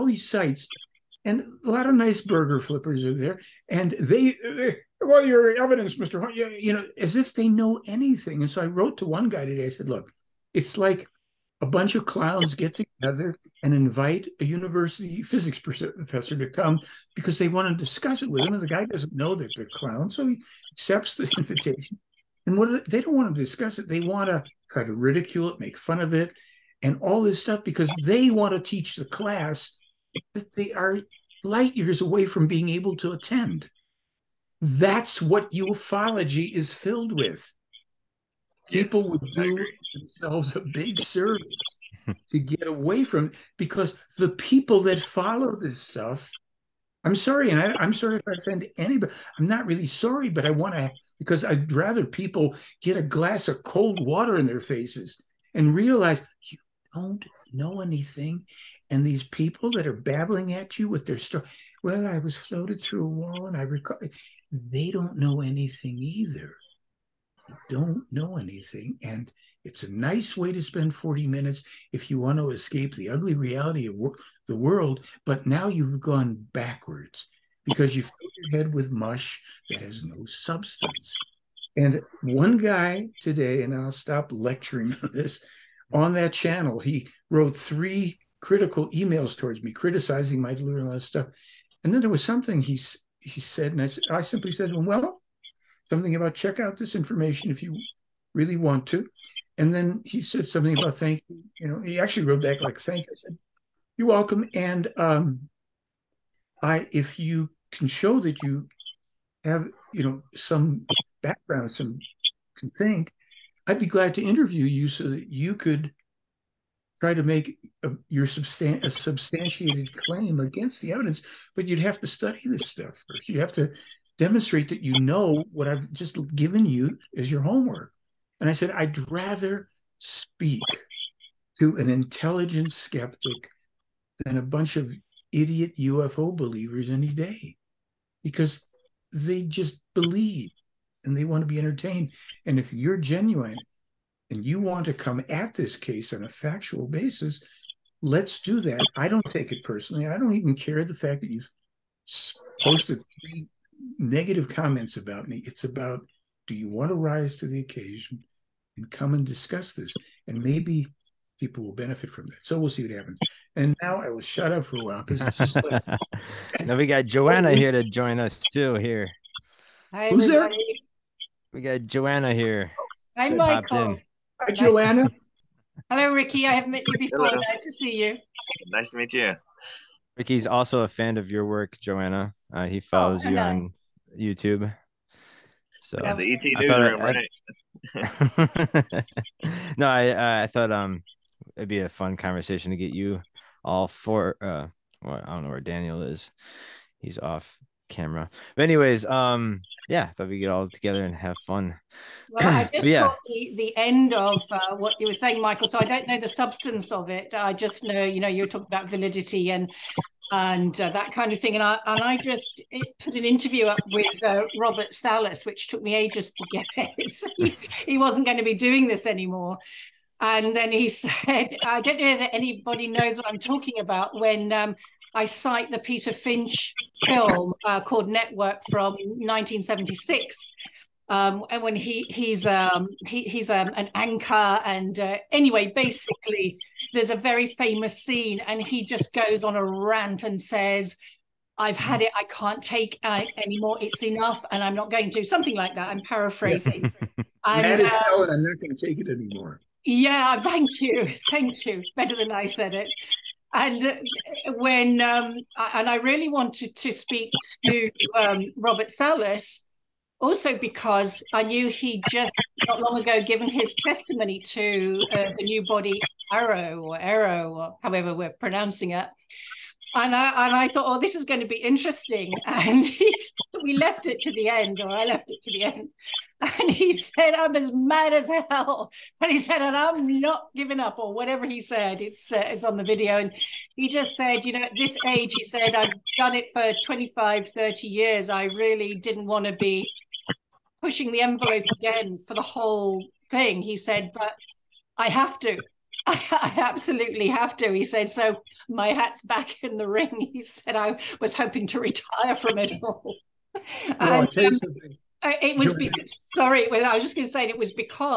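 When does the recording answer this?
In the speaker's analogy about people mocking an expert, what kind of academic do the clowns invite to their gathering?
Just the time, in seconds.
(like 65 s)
14 s.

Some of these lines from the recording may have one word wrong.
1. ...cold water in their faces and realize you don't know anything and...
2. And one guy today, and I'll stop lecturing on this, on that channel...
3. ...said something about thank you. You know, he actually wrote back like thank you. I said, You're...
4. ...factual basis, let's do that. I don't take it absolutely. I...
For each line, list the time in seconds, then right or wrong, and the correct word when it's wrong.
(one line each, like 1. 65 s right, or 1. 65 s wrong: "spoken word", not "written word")
1. 53 s right
2. 81 s right
3. 100 s right
4. 146 s wrong: "personally", not "absolutely".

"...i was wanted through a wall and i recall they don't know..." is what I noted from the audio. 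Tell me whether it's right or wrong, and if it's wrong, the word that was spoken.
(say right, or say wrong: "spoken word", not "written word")
wrong: "floated", not "wanted".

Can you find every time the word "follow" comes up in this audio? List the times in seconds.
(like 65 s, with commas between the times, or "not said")
44 s, 182 s.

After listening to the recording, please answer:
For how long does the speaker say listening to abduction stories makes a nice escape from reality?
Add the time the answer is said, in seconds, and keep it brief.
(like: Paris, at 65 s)
40 minutes, at 70 s.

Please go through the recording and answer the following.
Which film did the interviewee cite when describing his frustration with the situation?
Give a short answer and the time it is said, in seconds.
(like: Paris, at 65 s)
Network, at 228 s.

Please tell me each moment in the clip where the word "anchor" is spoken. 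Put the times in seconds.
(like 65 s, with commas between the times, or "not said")
233 s.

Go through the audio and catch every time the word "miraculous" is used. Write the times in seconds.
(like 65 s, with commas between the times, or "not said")
not said.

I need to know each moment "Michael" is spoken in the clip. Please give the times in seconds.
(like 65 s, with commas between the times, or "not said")
173 s, 205 s.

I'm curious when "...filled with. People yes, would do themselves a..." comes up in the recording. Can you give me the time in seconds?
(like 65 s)
36 s.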